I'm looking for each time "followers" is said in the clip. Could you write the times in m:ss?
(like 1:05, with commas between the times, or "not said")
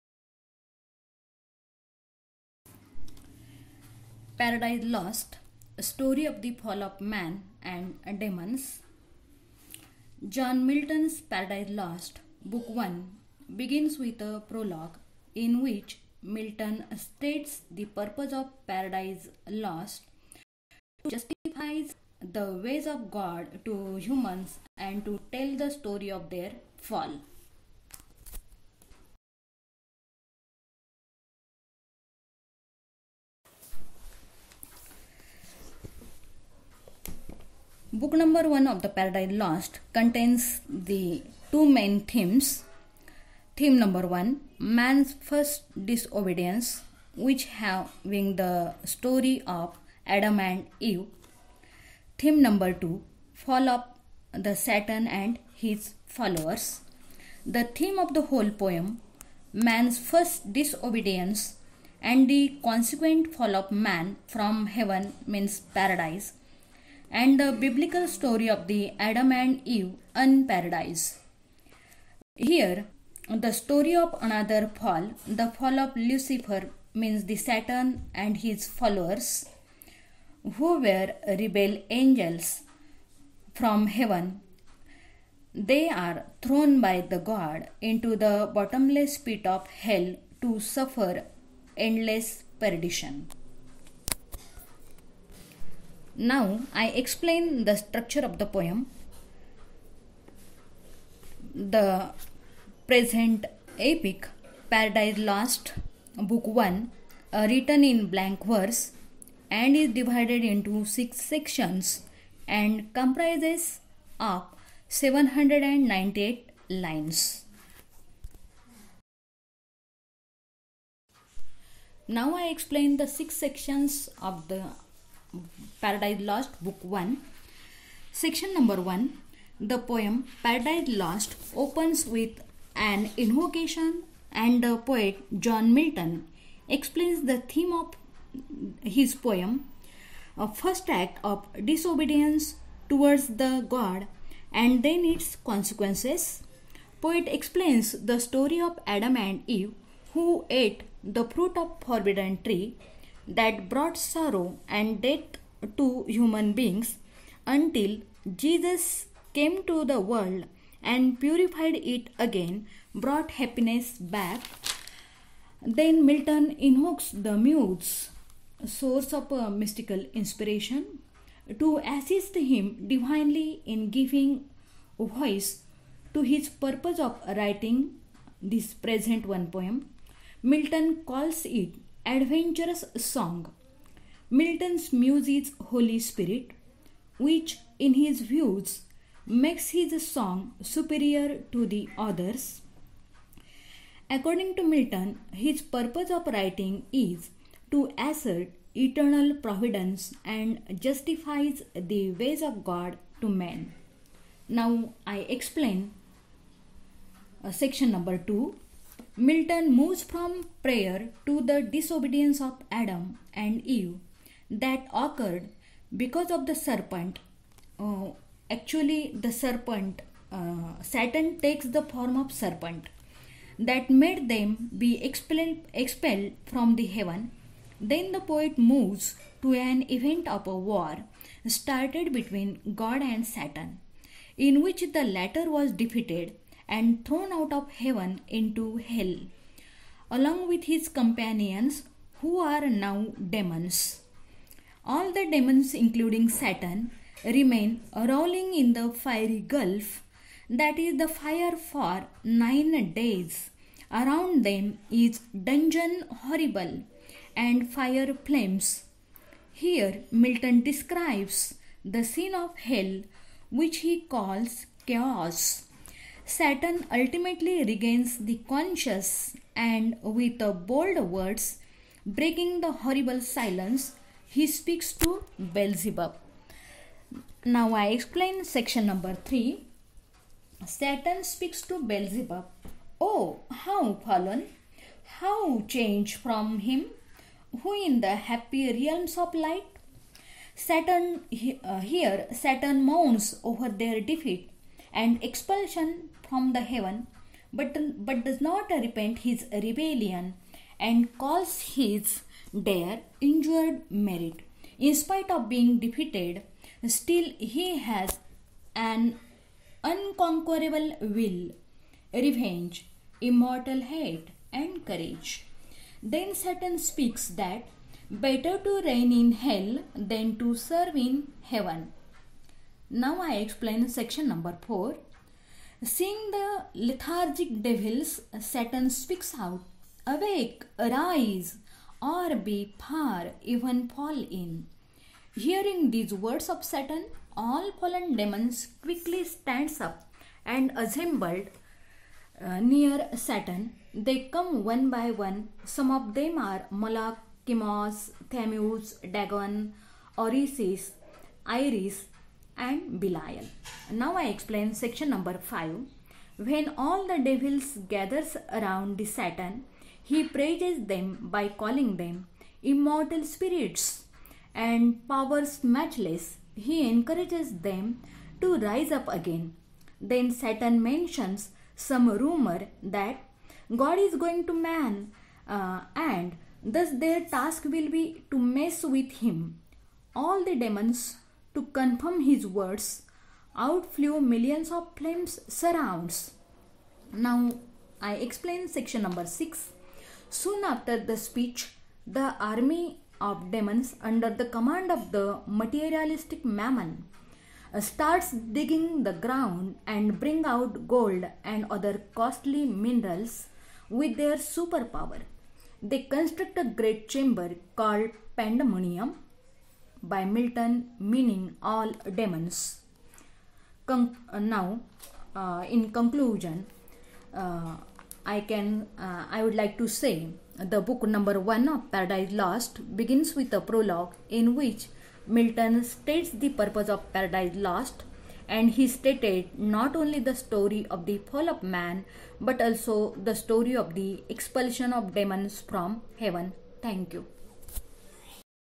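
0:56, 1:18.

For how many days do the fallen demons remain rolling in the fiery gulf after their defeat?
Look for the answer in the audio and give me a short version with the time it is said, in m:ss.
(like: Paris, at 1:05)
9, at 4:12.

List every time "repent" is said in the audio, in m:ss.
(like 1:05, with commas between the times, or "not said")
4:58.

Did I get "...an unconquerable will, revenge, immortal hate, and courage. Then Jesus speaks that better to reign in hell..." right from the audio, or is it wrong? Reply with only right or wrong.
wrong.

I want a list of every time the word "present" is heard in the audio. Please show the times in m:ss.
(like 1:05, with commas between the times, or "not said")
1:42, 2:58.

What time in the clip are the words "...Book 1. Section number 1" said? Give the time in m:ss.
2:06.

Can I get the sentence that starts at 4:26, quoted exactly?
Satan ultimately regains the conscious and with bold words, breaking the horrible silence, he speaks to Beelzebub.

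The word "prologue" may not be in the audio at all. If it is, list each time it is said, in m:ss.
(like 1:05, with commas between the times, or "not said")
0:14, 7:03.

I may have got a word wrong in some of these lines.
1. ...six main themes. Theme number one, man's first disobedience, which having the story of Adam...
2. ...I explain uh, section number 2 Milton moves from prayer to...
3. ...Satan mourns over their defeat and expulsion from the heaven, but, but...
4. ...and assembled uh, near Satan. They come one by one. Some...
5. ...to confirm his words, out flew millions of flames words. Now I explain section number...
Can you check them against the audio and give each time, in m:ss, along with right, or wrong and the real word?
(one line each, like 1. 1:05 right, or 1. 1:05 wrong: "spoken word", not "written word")
1. 0:41 wrong: "two", not "six"
2. 3:25 right
3. 4:52 right
4. 5:40 right
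5. 6:21 wrong: "surrounds", not "words".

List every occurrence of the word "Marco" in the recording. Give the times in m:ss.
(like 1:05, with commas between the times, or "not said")
not said.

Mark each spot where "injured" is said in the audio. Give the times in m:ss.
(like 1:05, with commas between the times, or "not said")
5:03.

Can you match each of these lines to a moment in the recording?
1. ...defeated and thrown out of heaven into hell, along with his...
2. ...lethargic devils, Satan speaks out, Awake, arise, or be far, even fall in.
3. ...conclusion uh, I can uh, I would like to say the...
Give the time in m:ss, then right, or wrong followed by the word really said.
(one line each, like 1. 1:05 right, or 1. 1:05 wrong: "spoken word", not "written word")
1. 3:55 right
2. 5:26 right
3. 6:55 right.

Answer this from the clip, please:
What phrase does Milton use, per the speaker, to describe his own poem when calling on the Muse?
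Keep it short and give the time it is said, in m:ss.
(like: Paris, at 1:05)
adventurous song, at 3:02.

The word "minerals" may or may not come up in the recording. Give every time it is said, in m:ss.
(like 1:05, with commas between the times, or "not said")
6:42.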